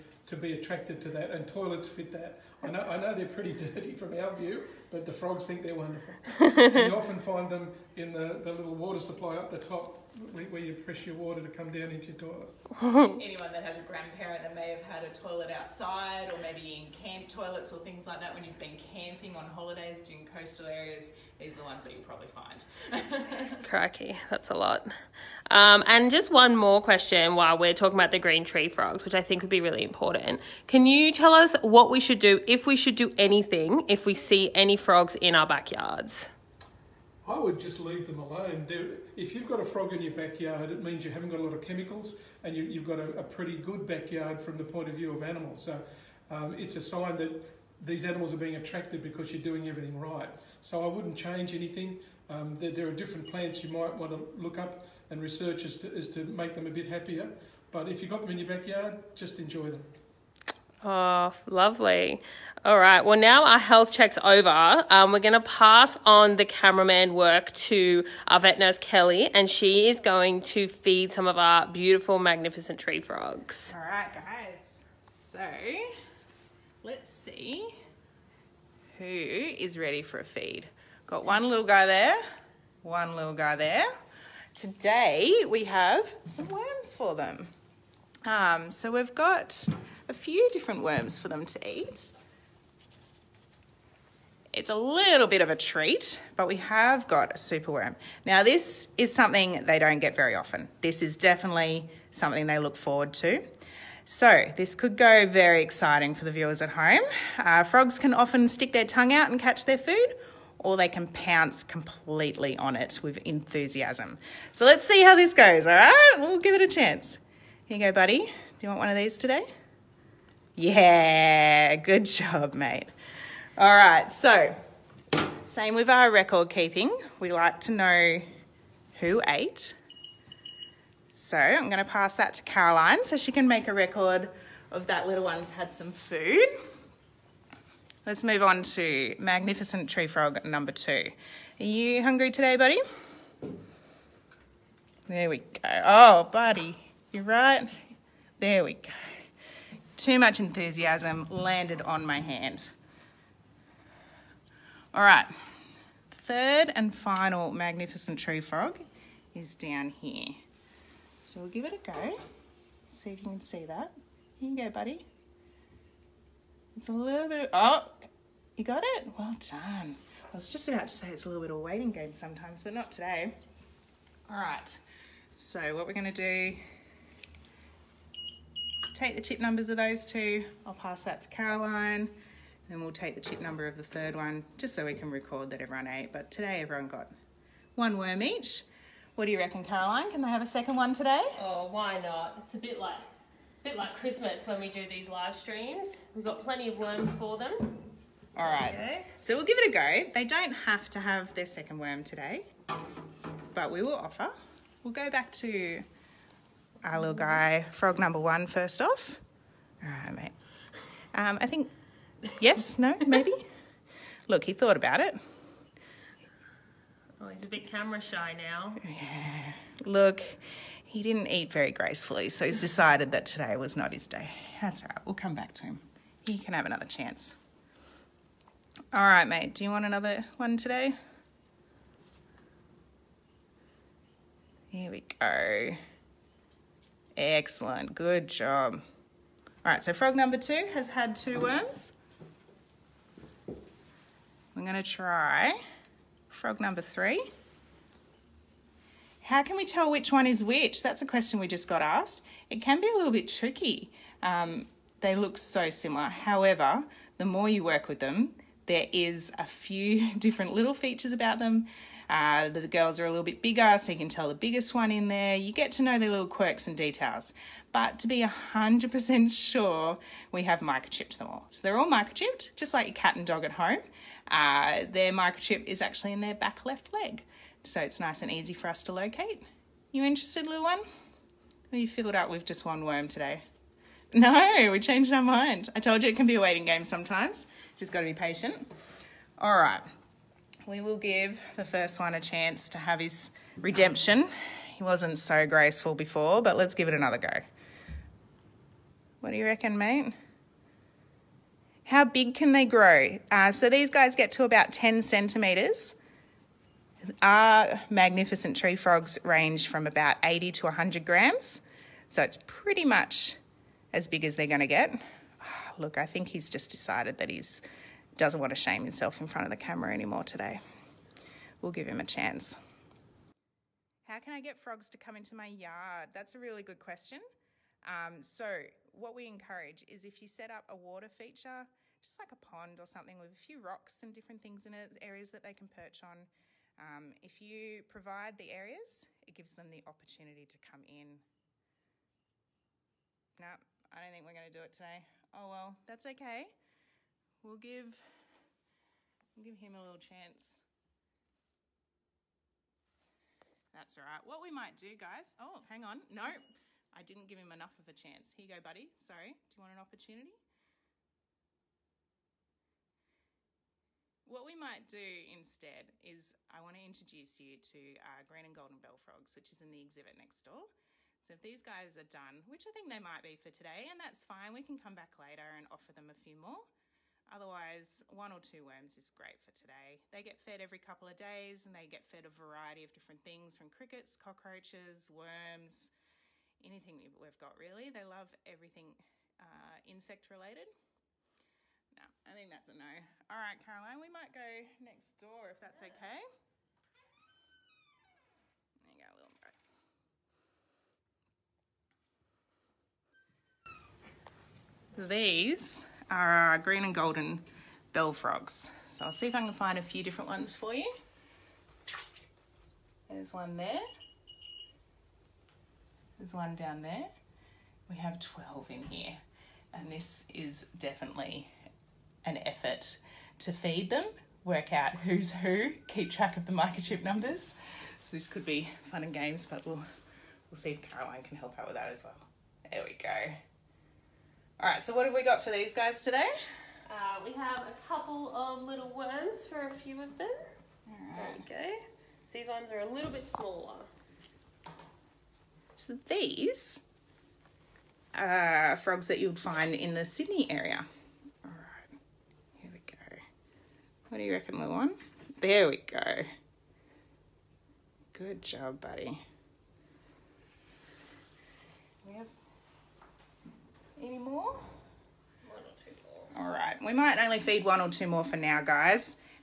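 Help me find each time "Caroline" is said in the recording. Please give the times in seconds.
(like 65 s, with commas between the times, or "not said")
132 s, 181 s, 189 s, 393 s, 430 s.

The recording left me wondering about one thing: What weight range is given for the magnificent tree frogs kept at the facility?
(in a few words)
80 to 100 grams.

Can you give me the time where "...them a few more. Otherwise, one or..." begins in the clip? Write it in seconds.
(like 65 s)
375 s.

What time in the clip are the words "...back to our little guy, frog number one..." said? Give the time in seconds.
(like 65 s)
205 s.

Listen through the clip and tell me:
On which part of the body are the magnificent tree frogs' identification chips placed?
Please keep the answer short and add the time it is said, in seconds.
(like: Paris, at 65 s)
back left leg, at 276 s.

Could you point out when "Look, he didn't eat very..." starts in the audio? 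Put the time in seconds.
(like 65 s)
219 s.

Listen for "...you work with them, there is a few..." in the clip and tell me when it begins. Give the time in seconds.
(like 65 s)
257 s.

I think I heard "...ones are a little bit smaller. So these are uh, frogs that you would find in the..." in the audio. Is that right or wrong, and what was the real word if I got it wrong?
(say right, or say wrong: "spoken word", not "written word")
right.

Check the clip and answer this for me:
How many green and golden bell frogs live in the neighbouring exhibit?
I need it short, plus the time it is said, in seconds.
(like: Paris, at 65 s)
12, at 418 s.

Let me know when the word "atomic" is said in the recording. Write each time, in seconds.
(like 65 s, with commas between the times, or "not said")
not said.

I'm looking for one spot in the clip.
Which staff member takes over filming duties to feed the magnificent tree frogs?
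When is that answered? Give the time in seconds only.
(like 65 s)
68 s.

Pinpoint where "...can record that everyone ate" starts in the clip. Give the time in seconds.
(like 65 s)
184 s.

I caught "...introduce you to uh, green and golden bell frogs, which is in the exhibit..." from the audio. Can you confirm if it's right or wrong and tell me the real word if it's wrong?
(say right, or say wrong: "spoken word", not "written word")
right.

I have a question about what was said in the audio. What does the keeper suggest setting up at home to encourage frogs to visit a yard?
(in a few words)
a water feature.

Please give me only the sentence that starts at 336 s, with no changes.
Um, if you provide the areas, it gives them the opportunity to come in.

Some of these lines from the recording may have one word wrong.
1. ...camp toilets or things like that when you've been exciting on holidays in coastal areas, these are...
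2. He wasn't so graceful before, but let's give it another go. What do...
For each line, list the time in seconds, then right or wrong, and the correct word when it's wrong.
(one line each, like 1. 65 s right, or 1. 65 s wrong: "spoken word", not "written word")
1. 16 s wrong: "camping", not "exciting"
2. 294 s right.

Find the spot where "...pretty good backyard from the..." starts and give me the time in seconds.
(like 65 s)
43 s.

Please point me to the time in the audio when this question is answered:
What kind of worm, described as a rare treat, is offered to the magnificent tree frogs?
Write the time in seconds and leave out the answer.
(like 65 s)
97 s.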